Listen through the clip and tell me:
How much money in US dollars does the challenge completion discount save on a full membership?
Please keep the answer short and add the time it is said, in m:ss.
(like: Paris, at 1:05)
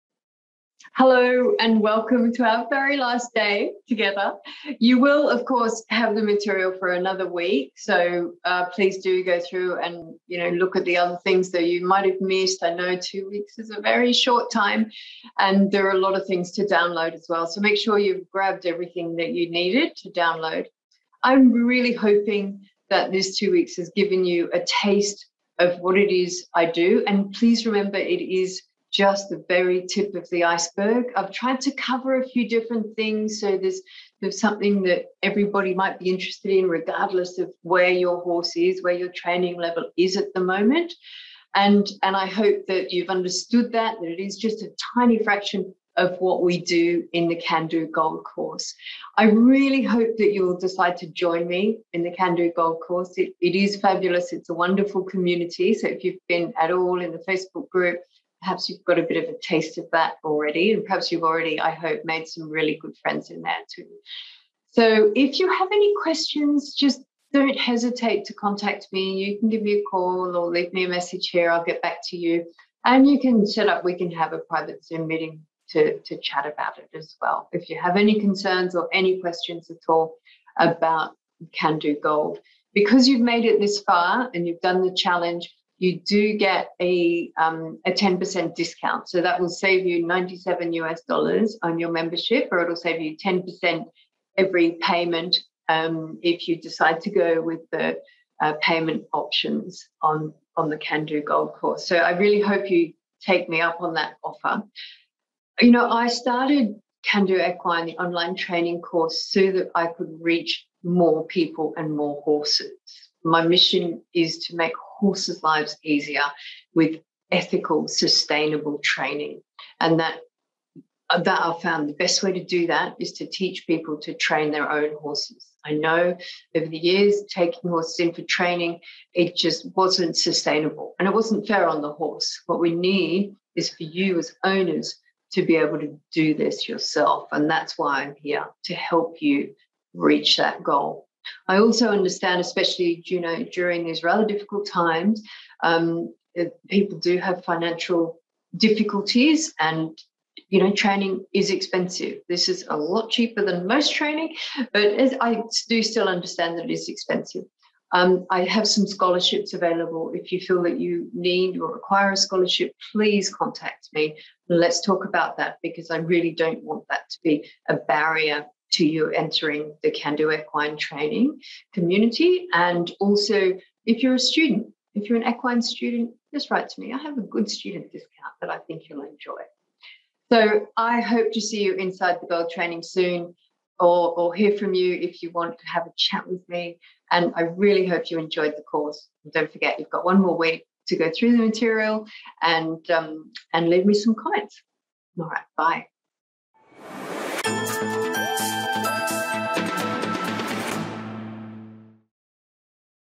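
97 US dollars, at 1:30.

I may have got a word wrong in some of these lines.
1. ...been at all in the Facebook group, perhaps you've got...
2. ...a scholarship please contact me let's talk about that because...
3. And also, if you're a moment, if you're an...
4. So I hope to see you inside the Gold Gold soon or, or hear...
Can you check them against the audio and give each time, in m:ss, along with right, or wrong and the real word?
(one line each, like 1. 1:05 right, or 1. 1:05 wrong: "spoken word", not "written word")
1. 0:56 right
2. 2:42 right
3. 2:52 wrong: "student", not "moment"
4. 3:00 wrong: "Training", not "Gold".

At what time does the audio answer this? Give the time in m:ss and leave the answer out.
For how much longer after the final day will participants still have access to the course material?
0:06.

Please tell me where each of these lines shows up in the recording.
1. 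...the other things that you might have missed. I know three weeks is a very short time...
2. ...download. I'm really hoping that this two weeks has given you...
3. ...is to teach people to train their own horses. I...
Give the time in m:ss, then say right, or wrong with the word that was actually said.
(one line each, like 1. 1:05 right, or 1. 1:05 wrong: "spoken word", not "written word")
1. 0:10 wrong: "two", not "three"
2. 0:20 right
3. 2:02 right.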